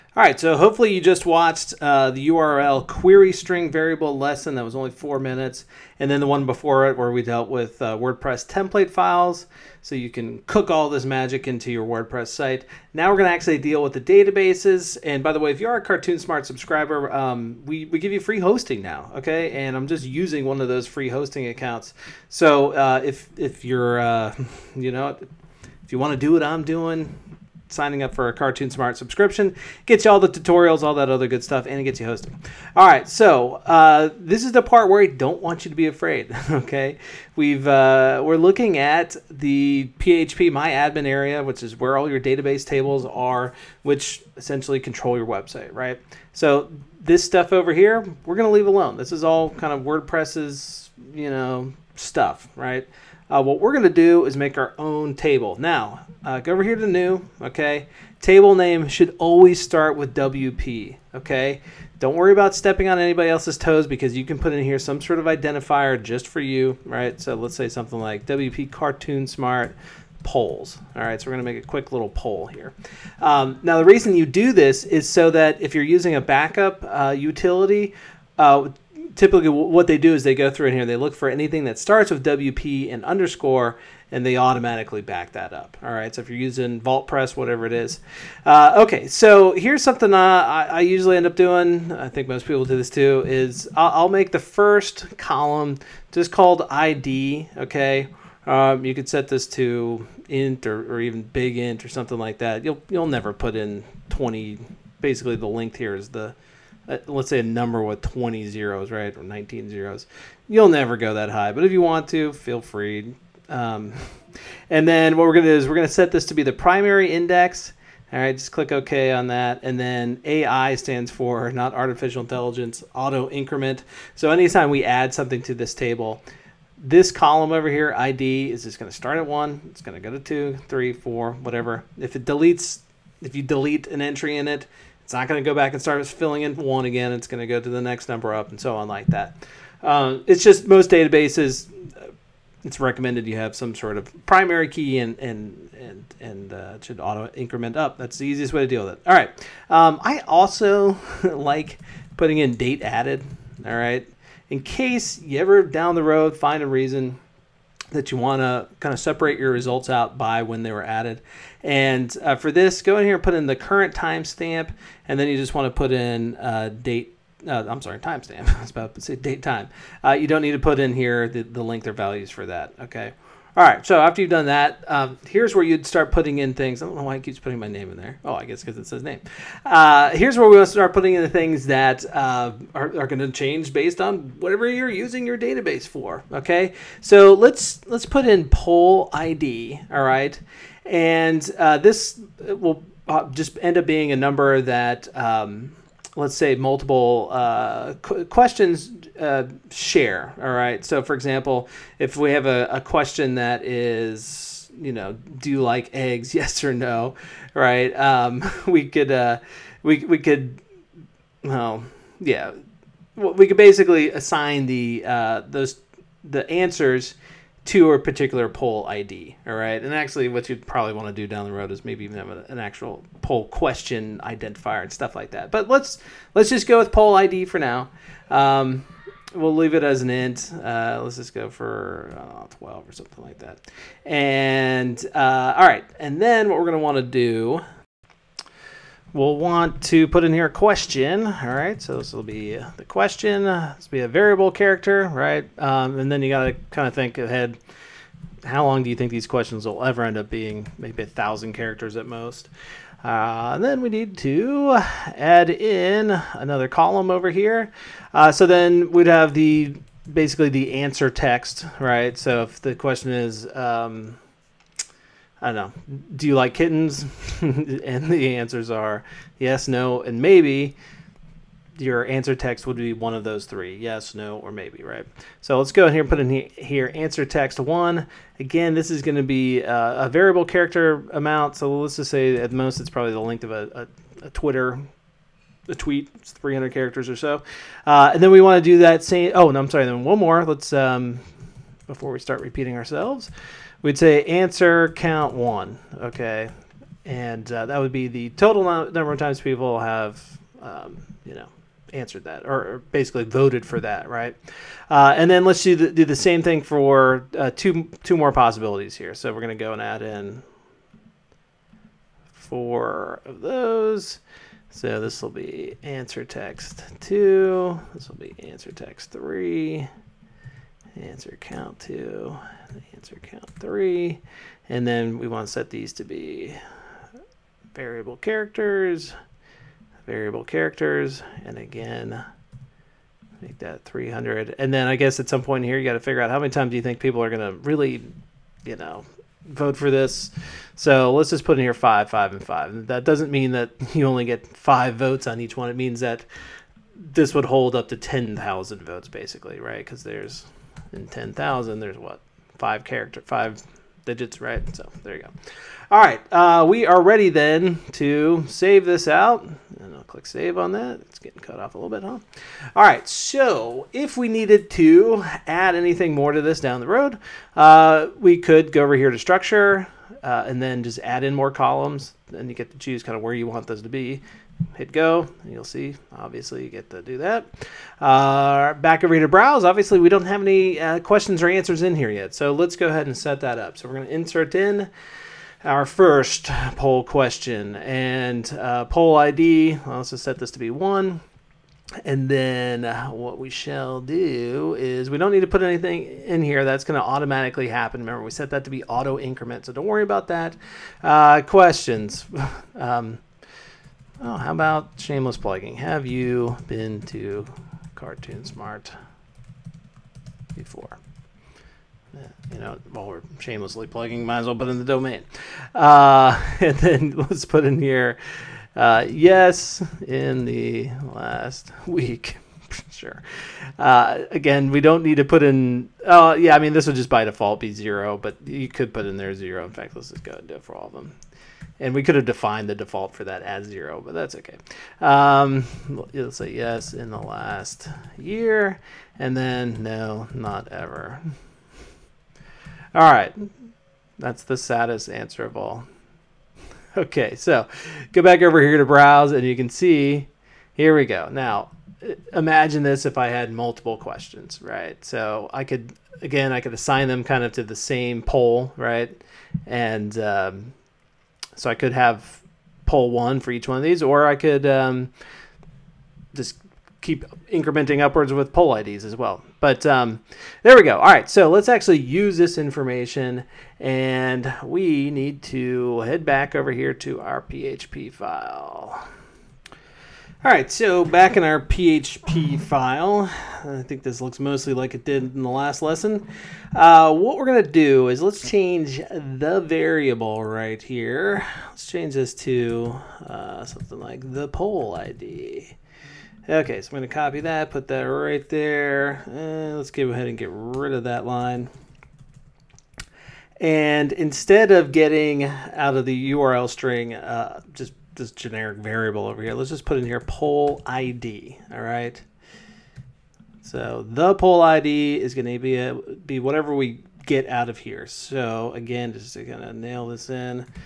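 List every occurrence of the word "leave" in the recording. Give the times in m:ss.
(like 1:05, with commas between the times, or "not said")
0:48, 3:49.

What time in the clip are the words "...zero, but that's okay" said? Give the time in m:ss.
7:13.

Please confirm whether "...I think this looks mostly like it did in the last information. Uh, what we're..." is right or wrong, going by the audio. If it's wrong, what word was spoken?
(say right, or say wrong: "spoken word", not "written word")
wrong: "lesson", not "information".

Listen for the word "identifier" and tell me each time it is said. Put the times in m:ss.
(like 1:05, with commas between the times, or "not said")
1:05, 3:44.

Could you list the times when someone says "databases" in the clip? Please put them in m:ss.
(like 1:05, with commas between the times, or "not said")
0:13, 0:42, 2:20, 3:05.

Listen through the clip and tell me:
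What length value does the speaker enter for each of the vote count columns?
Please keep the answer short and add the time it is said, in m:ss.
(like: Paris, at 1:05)
5, at 5:41.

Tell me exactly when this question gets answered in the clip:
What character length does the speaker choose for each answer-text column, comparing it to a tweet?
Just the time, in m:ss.
4:46.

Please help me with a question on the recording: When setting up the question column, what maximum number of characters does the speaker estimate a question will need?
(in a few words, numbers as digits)
1,000.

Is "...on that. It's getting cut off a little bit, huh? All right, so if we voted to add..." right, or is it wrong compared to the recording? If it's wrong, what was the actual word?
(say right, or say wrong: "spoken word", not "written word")
wrong: "needed", not "voted".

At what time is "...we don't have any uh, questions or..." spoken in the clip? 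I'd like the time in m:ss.
6:19.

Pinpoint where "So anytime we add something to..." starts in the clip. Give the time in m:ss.
2:04.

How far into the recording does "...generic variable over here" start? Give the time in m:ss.
8:28.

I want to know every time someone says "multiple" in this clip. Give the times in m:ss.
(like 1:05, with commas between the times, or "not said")
3:16, 7:33.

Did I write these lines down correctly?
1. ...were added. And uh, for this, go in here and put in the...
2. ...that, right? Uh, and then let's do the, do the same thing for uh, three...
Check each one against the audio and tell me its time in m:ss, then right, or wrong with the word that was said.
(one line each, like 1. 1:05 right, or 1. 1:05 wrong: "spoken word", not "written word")
1. 2:40 right
2. 5:03 wrong: "two", not "three".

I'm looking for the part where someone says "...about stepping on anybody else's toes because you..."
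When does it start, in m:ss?
1:02.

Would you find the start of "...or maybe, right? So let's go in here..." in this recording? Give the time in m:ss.
4:34.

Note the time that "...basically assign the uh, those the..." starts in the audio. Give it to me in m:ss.
3:33.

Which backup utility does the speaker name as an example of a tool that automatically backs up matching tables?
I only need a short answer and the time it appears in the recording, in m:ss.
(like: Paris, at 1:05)
VaultPress, at 1:26.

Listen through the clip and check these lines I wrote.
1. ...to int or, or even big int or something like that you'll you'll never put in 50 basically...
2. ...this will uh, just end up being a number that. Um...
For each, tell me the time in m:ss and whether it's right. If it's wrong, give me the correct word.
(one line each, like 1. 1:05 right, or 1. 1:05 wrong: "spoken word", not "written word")
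1. 1:39 wrong: "20", not "50"
2. 3:11 right.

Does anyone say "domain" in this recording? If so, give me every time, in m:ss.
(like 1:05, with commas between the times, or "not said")
6:54.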